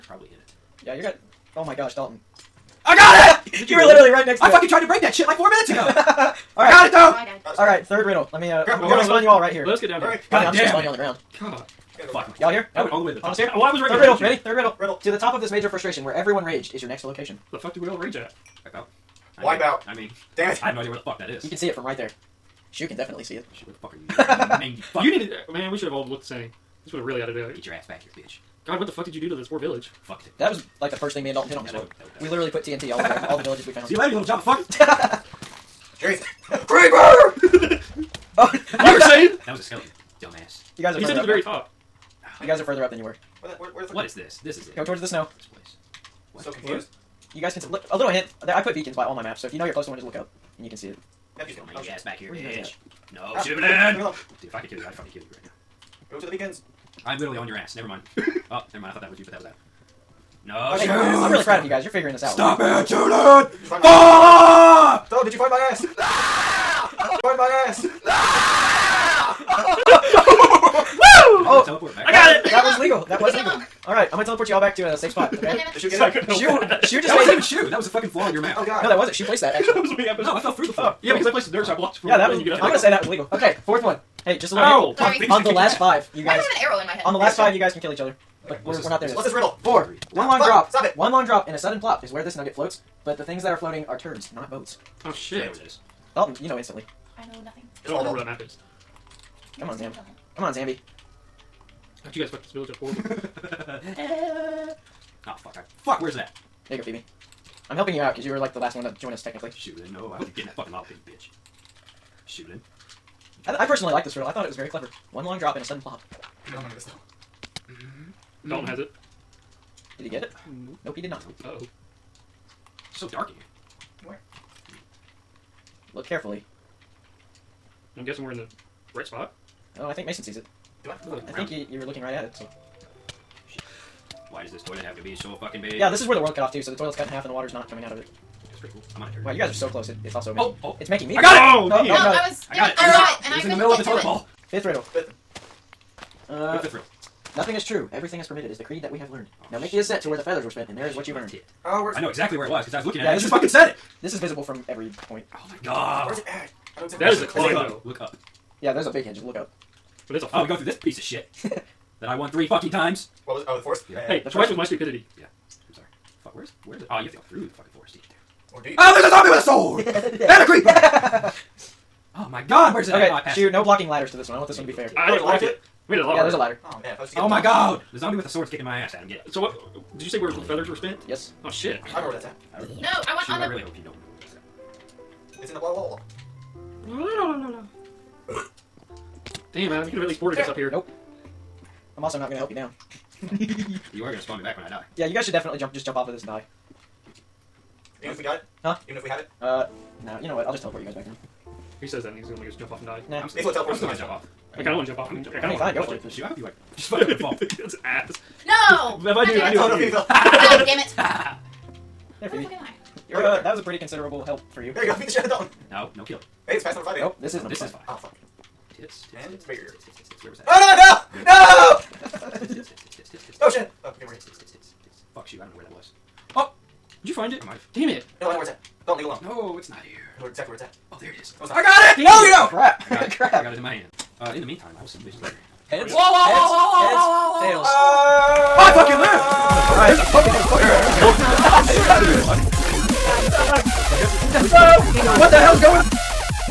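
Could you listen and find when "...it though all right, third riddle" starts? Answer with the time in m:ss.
0:06.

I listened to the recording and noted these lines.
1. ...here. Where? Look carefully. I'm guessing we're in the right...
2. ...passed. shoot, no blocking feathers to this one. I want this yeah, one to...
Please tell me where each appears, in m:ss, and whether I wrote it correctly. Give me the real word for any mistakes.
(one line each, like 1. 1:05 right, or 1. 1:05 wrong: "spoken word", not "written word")
1. 2:03 right
2. 2:53 wrong: "ladders", not "feathers".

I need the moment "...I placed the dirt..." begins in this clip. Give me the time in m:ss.
1:21.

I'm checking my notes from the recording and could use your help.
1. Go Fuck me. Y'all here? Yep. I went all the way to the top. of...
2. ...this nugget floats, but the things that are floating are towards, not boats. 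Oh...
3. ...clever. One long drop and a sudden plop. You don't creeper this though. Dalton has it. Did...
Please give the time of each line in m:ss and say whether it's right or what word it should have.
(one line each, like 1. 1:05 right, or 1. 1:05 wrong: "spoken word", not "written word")
1. 0:11 right
2. 1:32 wrong: "turds", not "towards"
3. 1:54 wrong: "remember", not "creeper".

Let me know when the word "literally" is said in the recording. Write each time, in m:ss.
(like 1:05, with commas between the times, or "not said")
0:03, 0:32, 0:57.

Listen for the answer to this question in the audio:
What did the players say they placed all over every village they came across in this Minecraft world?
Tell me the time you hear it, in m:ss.
0:32.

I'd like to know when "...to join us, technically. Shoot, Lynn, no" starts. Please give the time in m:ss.
1:48.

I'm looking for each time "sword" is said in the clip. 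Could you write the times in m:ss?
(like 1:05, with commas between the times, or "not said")
2:50, 2:58.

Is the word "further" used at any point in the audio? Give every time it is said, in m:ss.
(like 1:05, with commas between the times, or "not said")
0:42.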